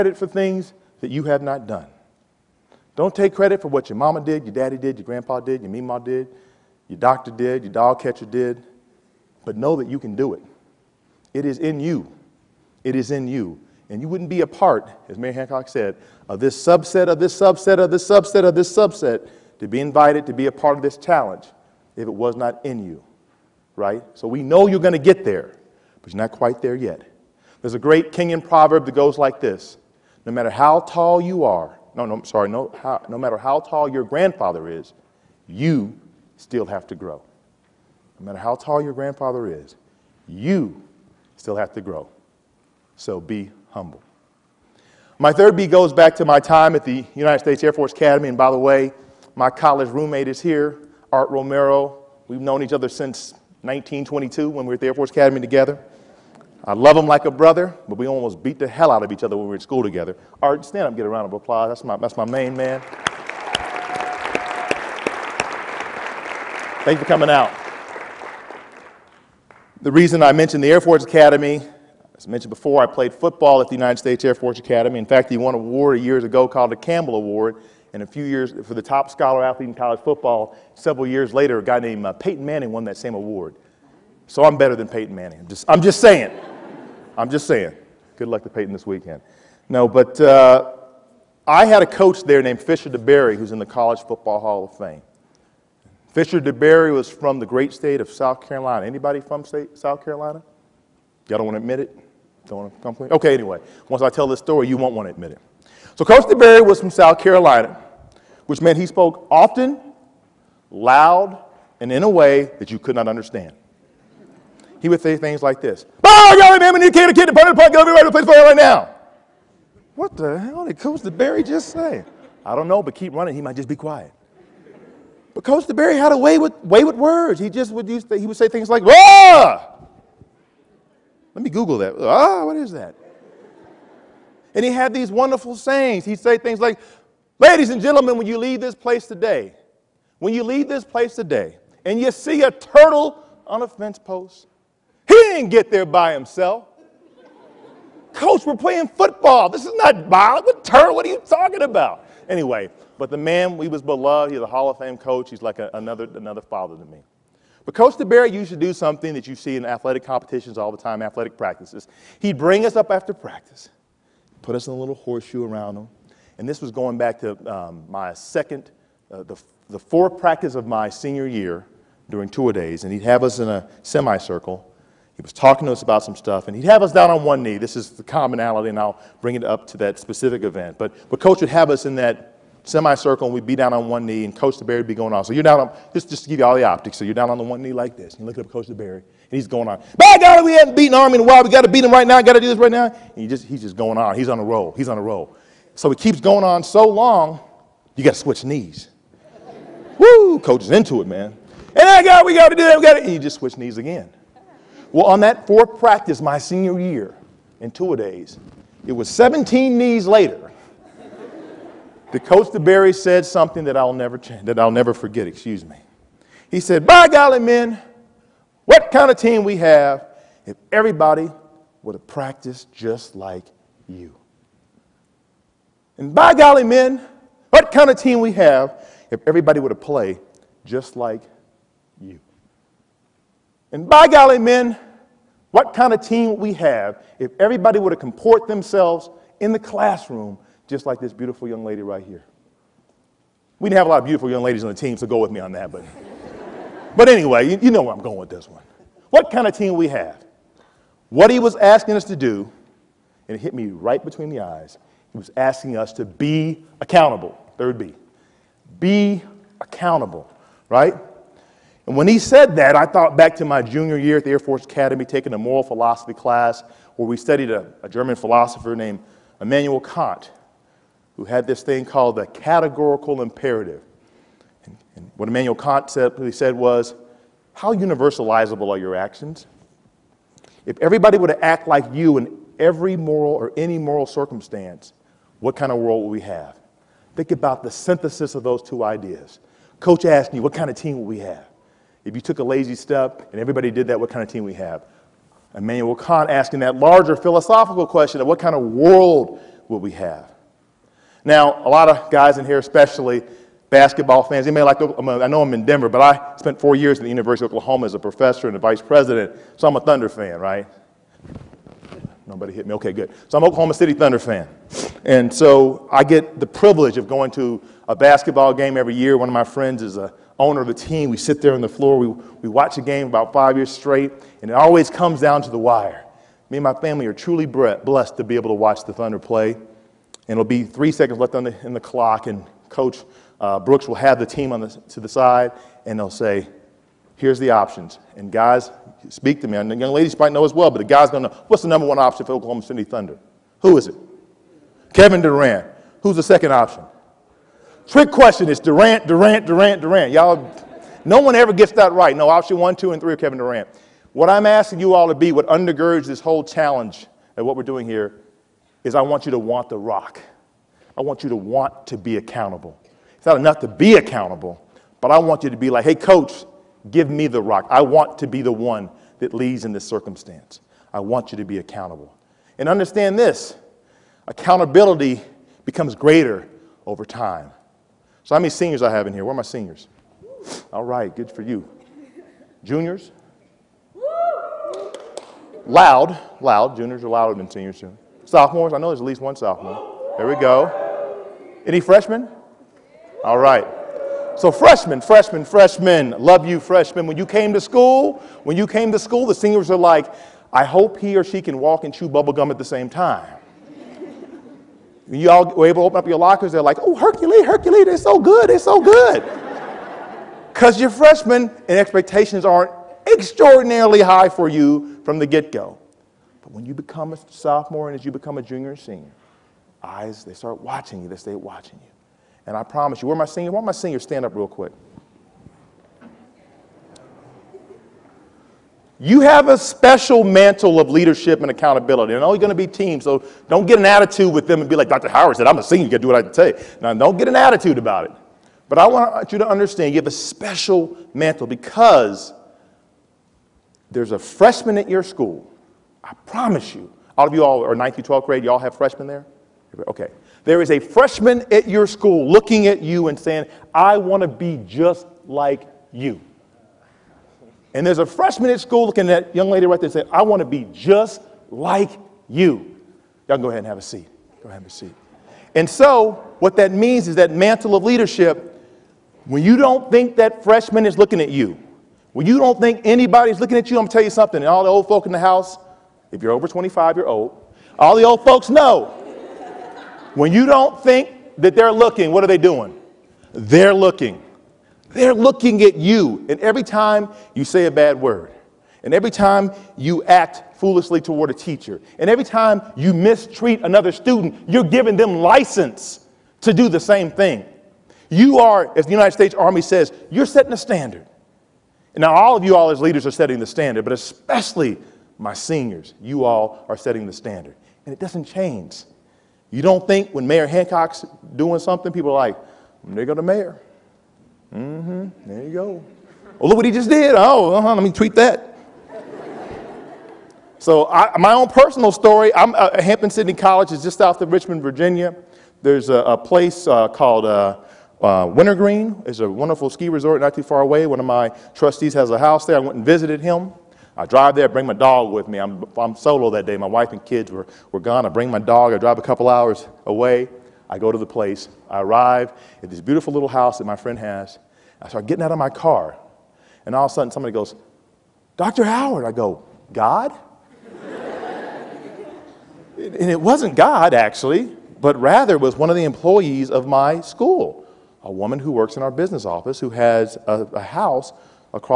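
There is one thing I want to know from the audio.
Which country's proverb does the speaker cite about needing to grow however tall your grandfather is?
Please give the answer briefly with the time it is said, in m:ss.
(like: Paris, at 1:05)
Kenyan, at 0:28.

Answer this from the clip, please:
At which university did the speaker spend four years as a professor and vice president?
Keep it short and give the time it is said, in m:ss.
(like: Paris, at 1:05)
University of Oklahoma, at 5:07.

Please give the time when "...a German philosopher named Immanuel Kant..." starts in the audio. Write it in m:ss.
4:27.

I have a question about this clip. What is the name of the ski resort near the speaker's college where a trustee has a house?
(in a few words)
Wintergreen.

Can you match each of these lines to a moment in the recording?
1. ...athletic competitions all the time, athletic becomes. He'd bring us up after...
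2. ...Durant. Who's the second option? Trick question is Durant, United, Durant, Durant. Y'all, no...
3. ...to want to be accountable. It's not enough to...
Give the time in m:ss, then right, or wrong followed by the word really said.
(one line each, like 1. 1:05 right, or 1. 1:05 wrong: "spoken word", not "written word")
1. 2:39 wrong: "practices", not "becomes"
2. 5:45 wrong: "Durant", not "United"
3. 6:01 right.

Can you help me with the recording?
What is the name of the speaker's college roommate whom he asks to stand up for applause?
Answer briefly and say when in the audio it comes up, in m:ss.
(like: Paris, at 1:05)
Art Romero, at 0:51.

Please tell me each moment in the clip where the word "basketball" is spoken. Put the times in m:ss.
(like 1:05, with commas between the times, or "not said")
5:03, 5:17.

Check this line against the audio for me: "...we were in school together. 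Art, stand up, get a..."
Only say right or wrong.
right.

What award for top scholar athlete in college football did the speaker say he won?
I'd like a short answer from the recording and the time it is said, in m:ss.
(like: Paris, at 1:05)
Campbell Award, at 1:16.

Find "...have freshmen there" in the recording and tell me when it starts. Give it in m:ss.
7:28.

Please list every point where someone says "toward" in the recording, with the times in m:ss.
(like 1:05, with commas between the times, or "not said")
8:11.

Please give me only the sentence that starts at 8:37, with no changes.
Oh, uh-huh, let me tweet that.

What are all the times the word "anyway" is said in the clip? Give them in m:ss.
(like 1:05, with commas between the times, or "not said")
1:43, 2:32, 4:07.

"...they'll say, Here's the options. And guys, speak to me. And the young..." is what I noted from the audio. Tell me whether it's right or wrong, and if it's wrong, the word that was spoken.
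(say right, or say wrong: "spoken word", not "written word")
right.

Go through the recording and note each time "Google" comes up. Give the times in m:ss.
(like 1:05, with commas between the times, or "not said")
2:11.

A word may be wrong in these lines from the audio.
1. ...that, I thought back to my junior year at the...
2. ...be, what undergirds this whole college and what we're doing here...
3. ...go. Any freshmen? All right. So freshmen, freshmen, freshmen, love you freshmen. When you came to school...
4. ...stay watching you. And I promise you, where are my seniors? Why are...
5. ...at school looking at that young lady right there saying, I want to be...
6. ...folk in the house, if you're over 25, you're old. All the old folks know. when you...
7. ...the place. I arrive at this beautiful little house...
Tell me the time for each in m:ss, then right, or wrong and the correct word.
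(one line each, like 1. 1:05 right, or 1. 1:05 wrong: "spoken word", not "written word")
1. 4:22 right
2. 5:55 wrong: "challenge", not "college"
3. 6:30 right
4. 7:01 right
5. 7:38 right
6. 7:54 right
7. 9:00 right.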